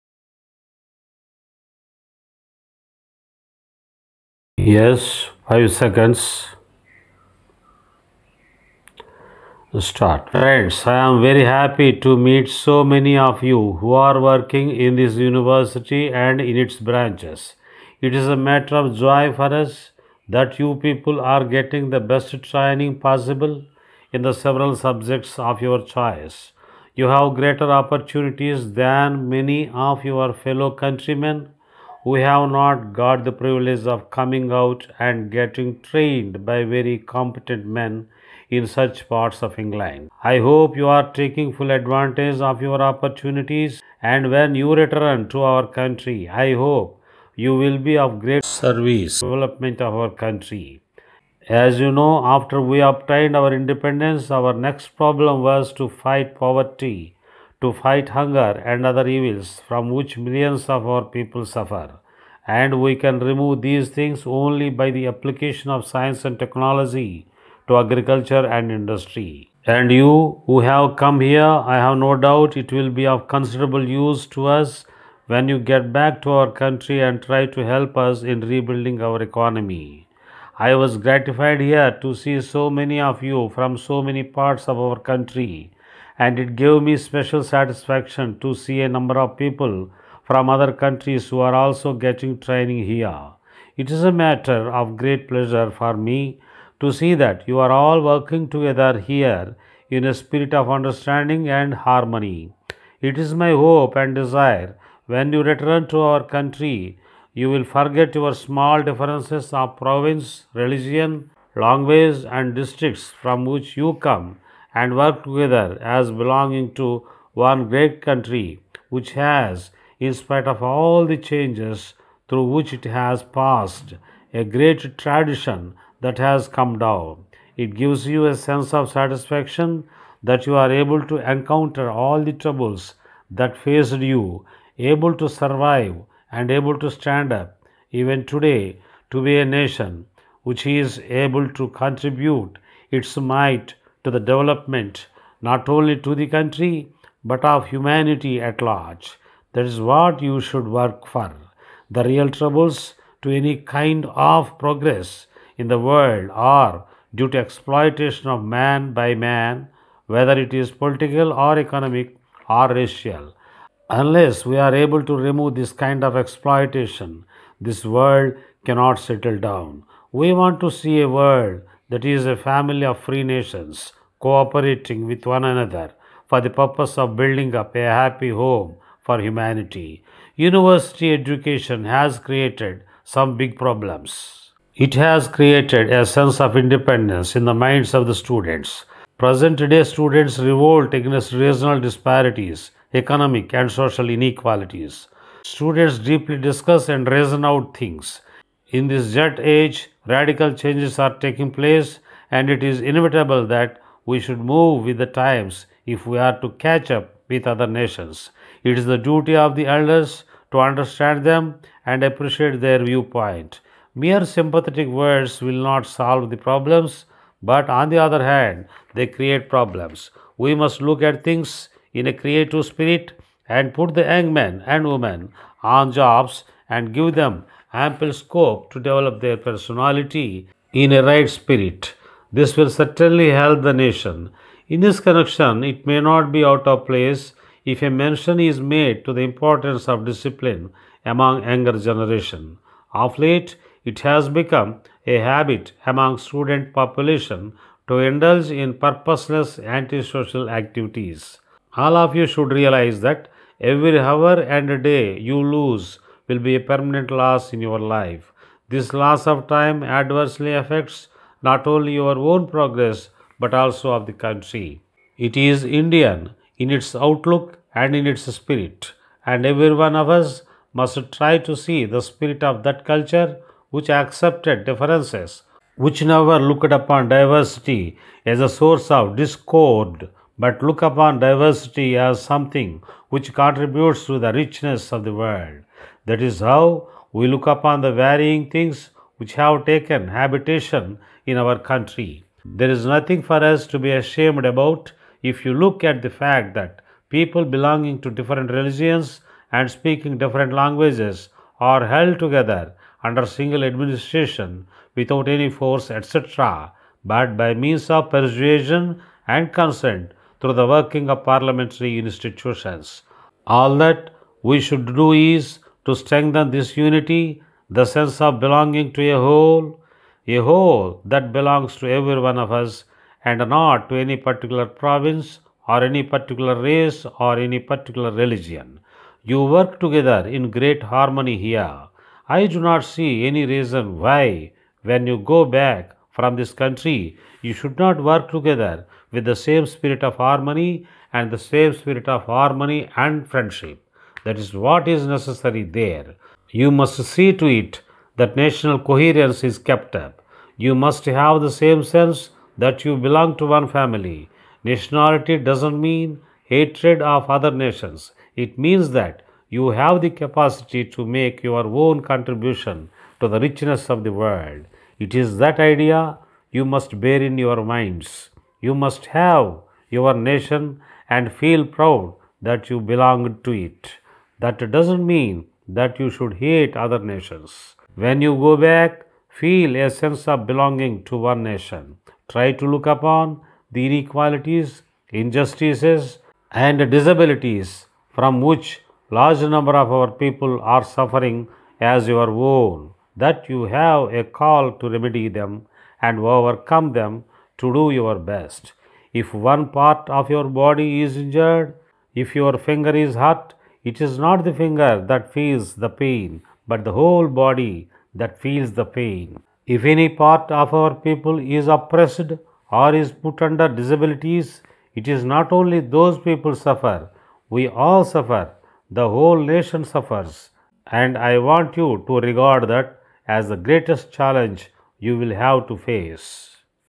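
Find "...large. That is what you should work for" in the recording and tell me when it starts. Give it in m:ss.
2:28.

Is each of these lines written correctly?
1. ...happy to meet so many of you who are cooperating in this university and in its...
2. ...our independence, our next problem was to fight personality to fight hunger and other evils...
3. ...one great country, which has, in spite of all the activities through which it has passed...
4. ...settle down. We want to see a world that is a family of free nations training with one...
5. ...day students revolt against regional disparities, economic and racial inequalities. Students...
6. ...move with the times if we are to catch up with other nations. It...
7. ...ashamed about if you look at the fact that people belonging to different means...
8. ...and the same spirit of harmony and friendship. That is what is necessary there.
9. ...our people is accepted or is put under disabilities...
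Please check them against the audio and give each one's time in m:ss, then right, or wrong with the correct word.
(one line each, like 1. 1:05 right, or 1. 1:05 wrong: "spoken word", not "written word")
1. 0:11 wrong: "working", not "cooperating"
2. 0:53 wrong: "poverty", not "personality"
3. 1:57 wrong: "changes", not "activities"
4. 2:48 wrong: "cooperating", not "training"
5. 3:09 wrong: "social", not "racial"
6. 3:24 right
7. 4:53 wrong: "religions", not "means"
8. 5:41 right
9. 6:50 wrong: "oppressed", not "accepted".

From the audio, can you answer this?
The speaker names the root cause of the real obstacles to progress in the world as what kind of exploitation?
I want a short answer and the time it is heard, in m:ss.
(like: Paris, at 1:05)
Exploitation of man by man, at 2:37.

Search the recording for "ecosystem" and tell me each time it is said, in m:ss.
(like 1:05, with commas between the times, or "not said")
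not said.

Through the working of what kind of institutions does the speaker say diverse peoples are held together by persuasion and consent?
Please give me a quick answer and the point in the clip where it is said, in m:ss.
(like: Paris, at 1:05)
Parliamentary institutions, at 5:11.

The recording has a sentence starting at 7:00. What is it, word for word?
And I want you to regard that as the greatest challenge you will have to face.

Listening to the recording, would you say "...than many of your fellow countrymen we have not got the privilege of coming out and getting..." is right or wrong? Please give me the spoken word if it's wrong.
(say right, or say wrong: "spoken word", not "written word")
right.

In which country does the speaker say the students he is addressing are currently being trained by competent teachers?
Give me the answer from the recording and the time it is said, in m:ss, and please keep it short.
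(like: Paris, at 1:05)
England, at 0:39.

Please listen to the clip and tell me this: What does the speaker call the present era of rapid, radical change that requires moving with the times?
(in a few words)
Jet age.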